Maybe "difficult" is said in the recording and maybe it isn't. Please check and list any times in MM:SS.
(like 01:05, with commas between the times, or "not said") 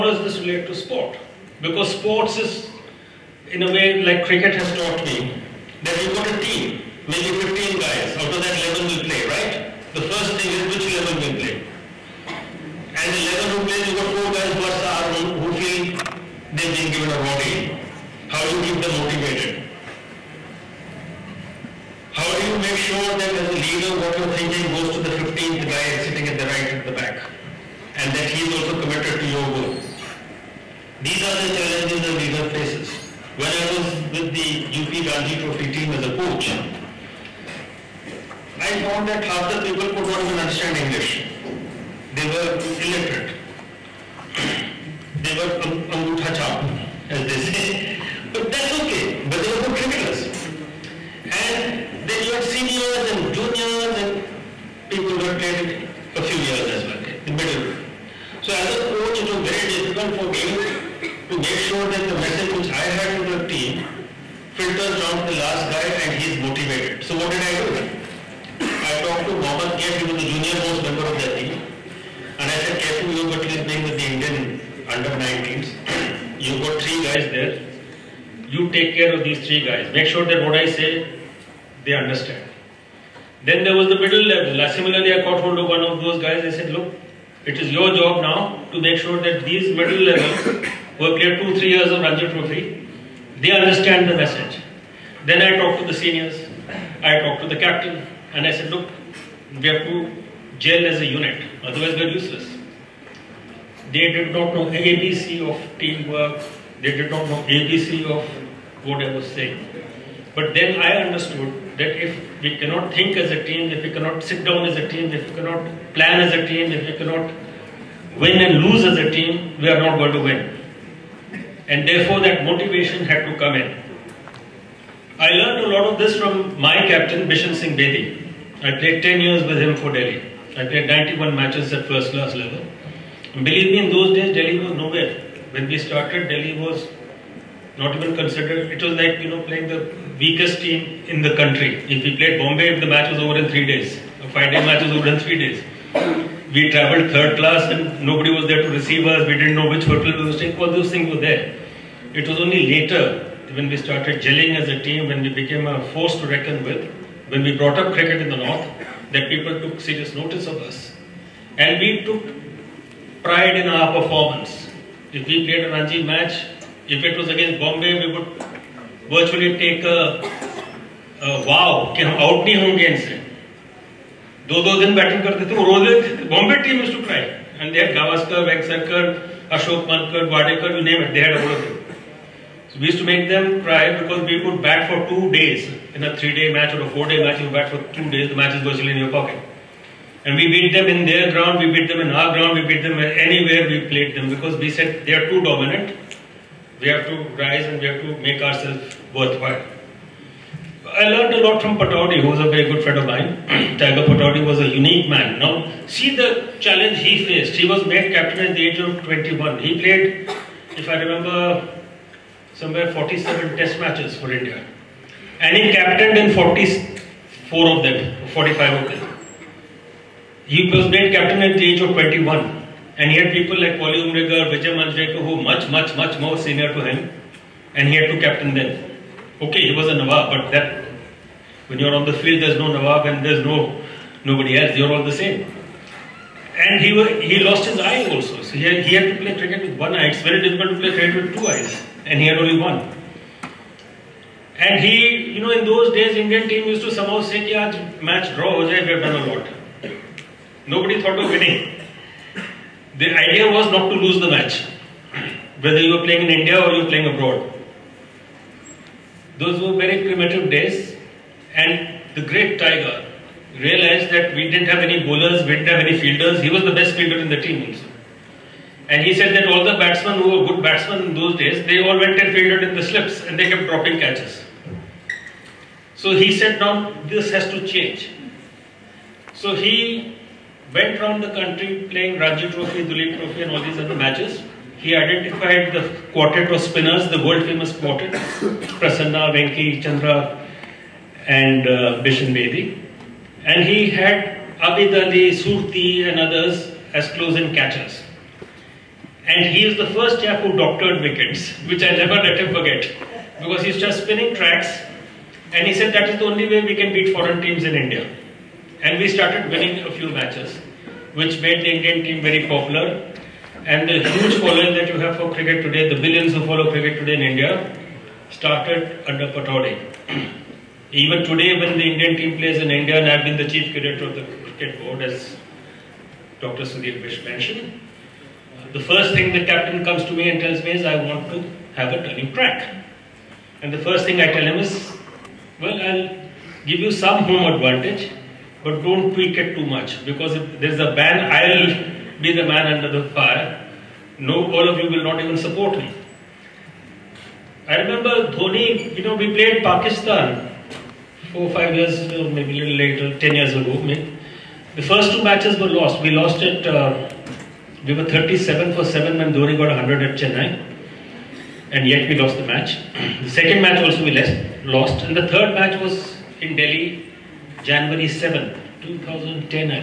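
00:59, 04:00.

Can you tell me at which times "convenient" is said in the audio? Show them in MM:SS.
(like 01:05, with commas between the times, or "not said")
not said.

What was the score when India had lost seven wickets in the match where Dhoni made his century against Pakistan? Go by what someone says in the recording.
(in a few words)
37 for 7.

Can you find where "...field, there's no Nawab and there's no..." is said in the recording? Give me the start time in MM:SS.
03:52.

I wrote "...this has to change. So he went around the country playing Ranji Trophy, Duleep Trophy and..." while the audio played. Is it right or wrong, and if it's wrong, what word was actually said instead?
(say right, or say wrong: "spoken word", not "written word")
right.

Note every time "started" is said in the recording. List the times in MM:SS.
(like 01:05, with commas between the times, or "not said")
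02:15, 02:33, 05:09, 05:18.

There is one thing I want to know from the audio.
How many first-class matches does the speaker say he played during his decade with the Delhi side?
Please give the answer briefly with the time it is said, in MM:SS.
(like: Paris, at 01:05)
91, at 02:10.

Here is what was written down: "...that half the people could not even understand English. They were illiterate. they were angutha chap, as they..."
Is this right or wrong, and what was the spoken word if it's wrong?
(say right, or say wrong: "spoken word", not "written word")
right.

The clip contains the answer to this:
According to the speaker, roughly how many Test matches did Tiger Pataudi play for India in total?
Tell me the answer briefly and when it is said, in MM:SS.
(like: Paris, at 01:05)
47, at 03:32.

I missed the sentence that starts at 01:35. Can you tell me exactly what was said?
Then I talked to the seniors.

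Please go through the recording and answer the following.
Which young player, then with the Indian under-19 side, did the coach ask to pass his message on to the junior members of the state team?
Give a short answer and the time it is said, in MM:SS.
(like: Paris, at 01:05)
Mohammad Kaif, at 01:09.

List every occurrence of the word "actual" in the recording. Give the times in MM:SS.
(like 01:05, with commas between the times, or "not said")
not said.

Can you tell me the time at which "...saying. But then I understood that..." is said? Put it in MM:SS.
01:49.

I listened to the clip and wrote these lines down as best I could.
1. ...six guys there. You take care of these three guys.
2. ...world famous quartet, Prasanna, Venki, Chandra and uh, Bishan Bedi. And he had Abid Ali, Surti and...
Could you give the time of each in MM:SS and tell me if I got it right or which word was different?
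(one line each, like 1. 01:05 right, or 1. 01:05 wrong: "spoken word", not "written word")
1. 01:16 wrong: "three", not "six"
2. 04:47 right.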